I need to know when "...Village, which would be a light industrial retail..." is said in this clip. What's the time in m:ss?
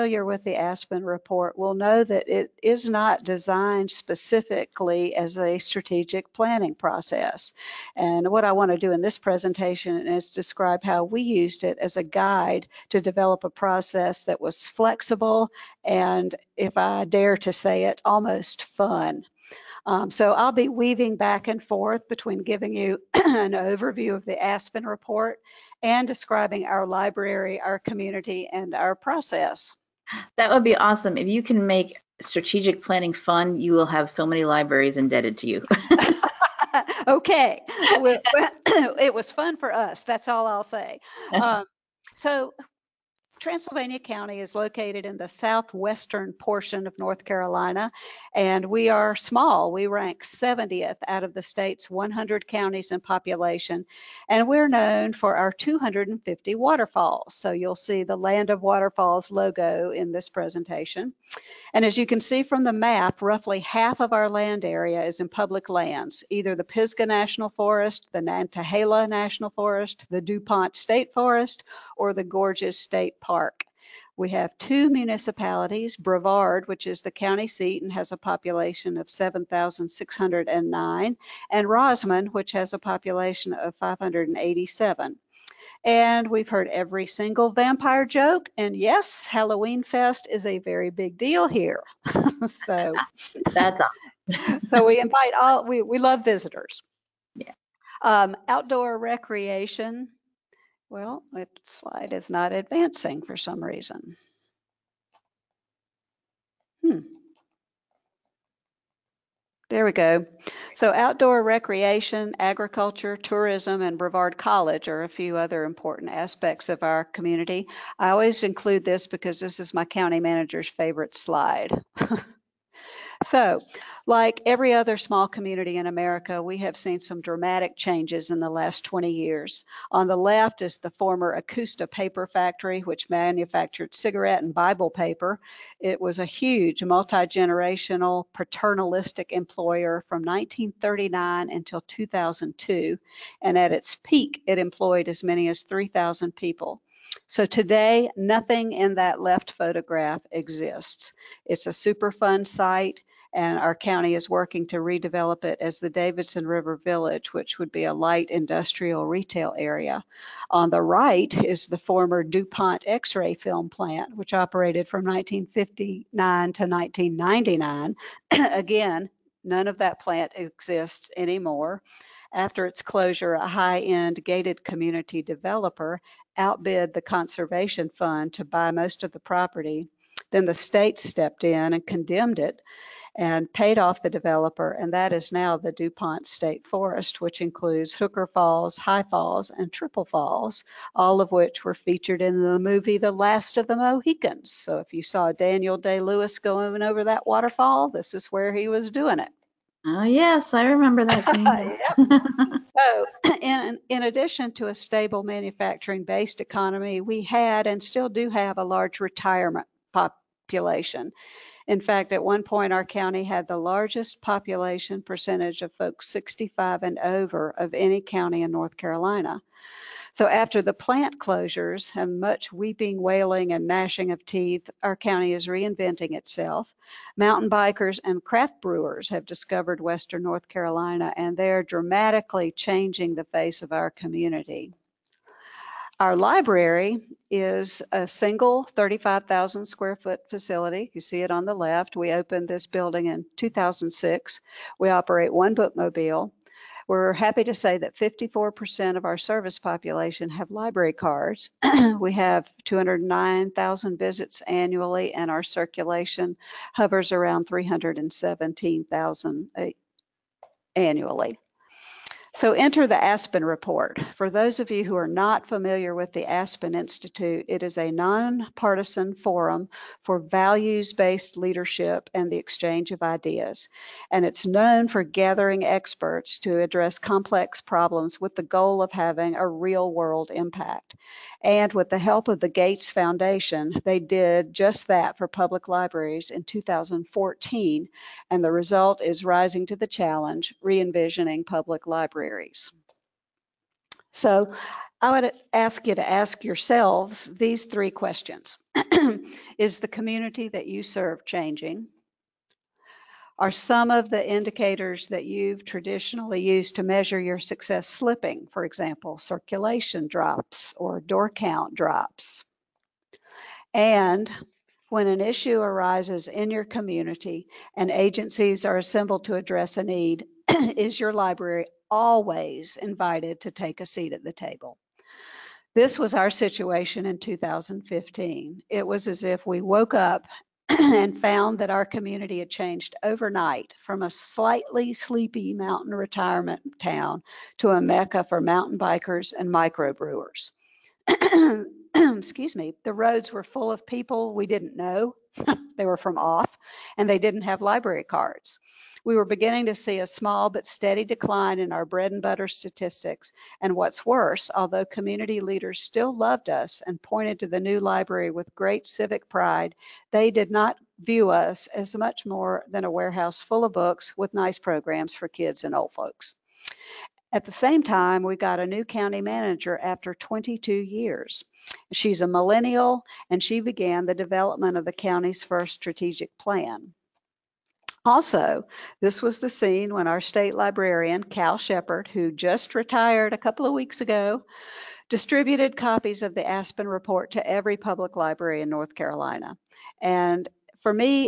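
2:36.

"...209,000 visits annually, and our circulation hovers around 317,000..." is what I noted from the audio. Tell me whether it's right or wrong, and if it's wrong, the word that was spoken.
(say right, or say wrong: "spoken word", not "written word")
right.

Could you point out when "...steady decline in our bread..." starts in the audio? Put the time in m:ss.
5:50.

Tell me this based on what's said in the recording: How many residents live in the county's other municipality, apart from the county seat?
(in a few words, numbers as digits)
587.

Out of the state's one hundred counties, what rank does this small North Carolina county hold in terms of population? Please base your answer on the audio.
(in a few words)
70th.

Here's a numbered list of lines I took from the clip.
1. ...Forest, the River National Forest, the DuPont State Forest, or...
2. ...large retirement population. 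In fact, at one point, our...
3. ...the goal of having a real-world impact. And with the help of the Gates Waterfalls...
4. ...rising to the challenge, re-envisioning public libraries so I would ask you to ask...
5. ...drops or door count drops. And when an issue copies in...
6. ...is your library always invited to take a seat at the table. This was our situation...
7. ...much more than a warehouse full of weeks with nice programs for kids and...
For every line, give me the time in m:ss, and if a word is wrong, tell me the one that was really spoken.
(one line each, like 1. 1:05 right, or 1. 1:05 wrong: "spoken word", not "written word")
1. 1:07 wrong: "Nantahala", not "River"
2. 3:28 right
3. 4:38 wrong: "Foundation", not "Waterfalls"
4. 4:49 right
5. 5:10 wrong: "arises", not "copies"
6. 5:20 right
7. 6:01 wrong: "books", not "weeks".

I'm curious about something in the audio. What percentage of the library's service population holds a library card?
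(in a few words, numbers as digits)
54%.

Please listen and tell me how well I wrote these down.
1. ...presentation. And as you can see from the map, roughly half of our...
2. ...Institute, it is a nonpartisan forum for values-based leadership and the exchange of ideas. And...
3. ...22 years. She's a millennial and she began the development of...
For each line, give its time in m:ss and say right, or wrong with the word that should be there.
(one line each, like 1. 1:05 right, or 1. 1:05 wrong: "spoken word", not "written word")
1. 1:00 right
2. 4:26 right
3. 6:10 right.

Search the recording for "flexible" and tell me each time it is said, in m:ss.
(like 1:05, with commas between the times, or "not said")
0:14.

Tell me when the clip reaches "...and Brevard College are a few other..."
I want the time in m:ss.
1:53.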